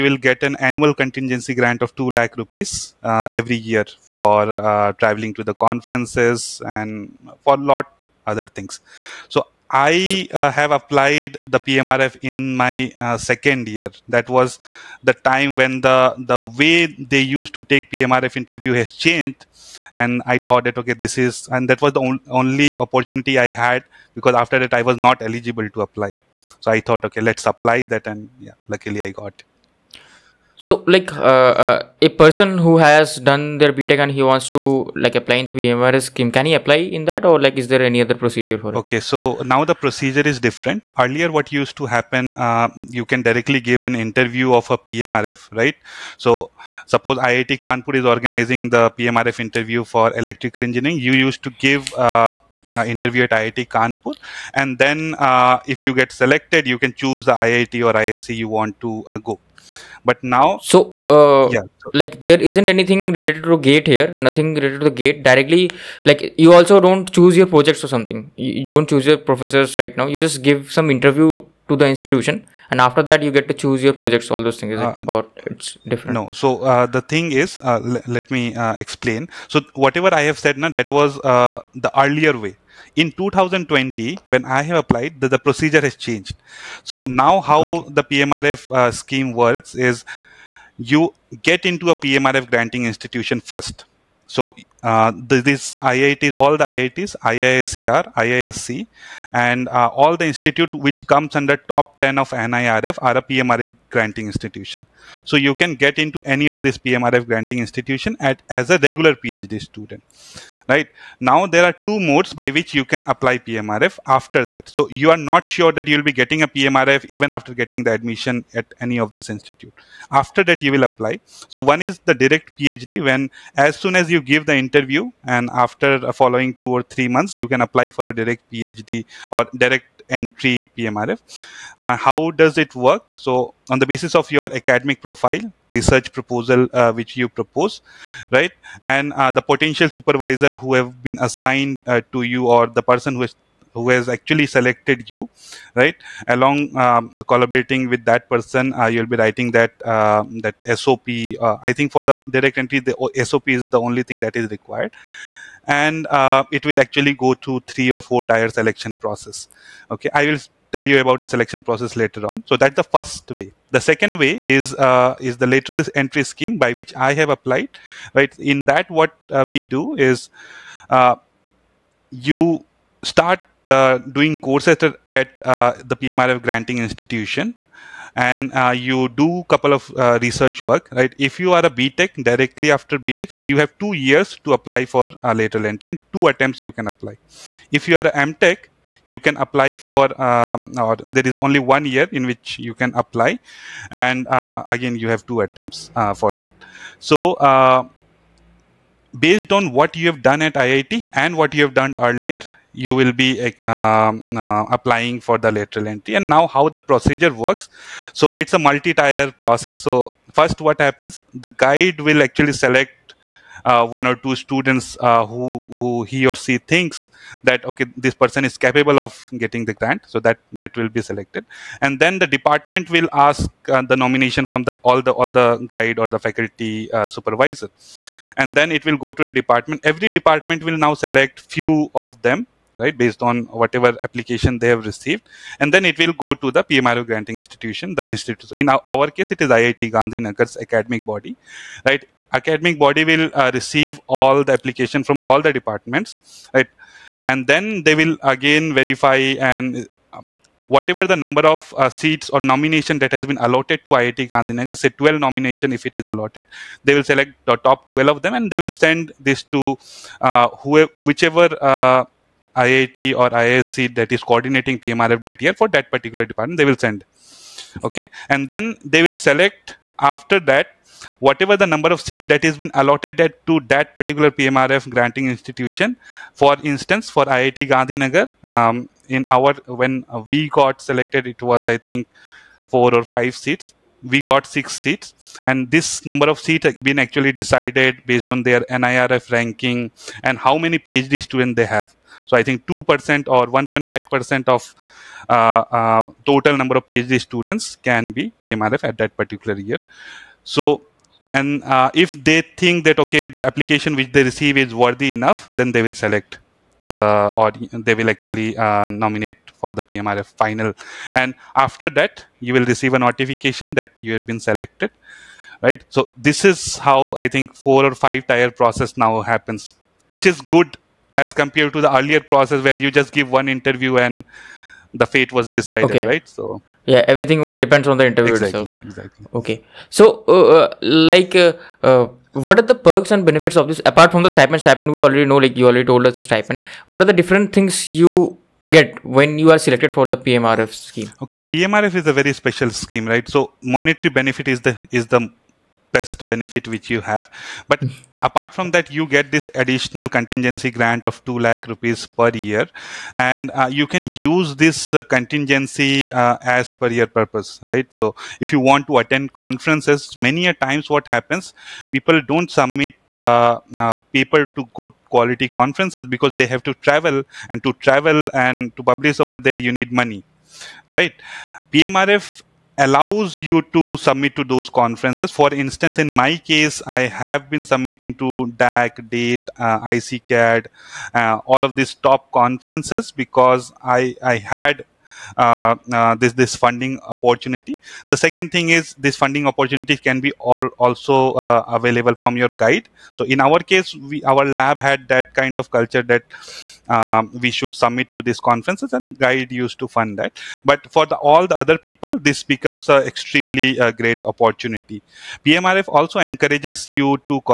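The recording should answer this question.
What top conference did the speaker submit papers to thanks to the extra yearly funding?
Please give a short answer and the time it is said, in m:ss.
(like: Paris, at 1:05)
DAC, at 6:18.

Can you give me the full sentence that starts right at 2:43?
The second way is uh, is the lateral entry scheme by which I have applied.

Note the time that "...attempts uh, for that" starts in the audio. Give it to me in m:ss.
3:15.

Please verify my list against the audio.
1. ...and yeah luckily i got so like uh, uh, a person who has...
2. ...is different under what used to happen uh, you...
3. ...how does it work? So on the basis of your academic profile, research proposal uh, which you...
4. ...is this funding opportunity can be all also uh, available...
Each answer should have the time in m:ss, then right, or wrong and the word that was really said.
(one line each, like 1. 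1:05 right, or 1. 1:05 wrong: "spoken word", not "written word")
1. 0:28 right
2. 0:40 wrong: "earlier", not "under"
3. 2:11 right
4. 6:28 right.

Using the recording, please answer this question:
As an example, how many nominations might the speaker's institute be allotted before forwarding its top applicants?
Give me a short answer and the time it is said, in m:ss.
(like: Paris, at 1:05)
12, at 4:14.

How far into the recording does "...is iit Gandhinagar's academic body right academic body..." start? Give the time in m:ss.
3:59.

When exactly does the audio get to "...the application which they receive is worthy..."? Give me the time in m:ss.
5:03.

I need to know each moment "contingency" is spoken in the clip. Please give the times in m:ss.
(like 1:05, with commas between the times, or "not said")
0:00, 5:50, 5:55.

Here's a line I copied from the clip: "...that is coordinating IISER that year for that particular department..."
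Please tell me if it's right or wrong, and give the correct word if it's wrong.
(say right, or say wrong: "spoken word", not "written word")
wrong: "PMRF", not "IISER".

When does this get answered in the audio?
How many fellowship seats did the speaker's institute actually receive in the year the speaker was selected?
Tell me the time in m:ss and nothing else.
4:44.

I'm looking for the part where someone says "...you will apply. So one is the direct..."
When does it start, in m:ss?
2:00.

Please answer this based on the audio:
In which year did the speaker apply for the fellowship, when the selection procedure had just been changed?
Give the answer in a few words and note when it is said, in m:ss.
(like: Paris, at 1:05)
2020, at 1:23.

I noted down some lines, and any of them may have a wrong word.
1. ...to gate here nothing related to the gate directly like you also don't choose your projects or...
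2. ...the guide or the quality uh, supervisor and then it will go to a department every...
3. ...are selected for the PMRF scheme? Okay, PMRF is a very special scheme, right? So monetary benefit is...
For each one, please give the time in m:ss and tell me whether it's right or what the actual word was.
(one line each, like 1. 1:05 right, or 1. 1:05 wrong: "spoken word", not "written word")
1. 1:03 right
2. 3:45 wrong: "faculty", not "quality"
3. 5:39 right.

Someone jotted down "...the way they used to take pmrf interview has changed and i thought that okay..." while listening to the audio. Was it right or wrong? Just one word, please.
right.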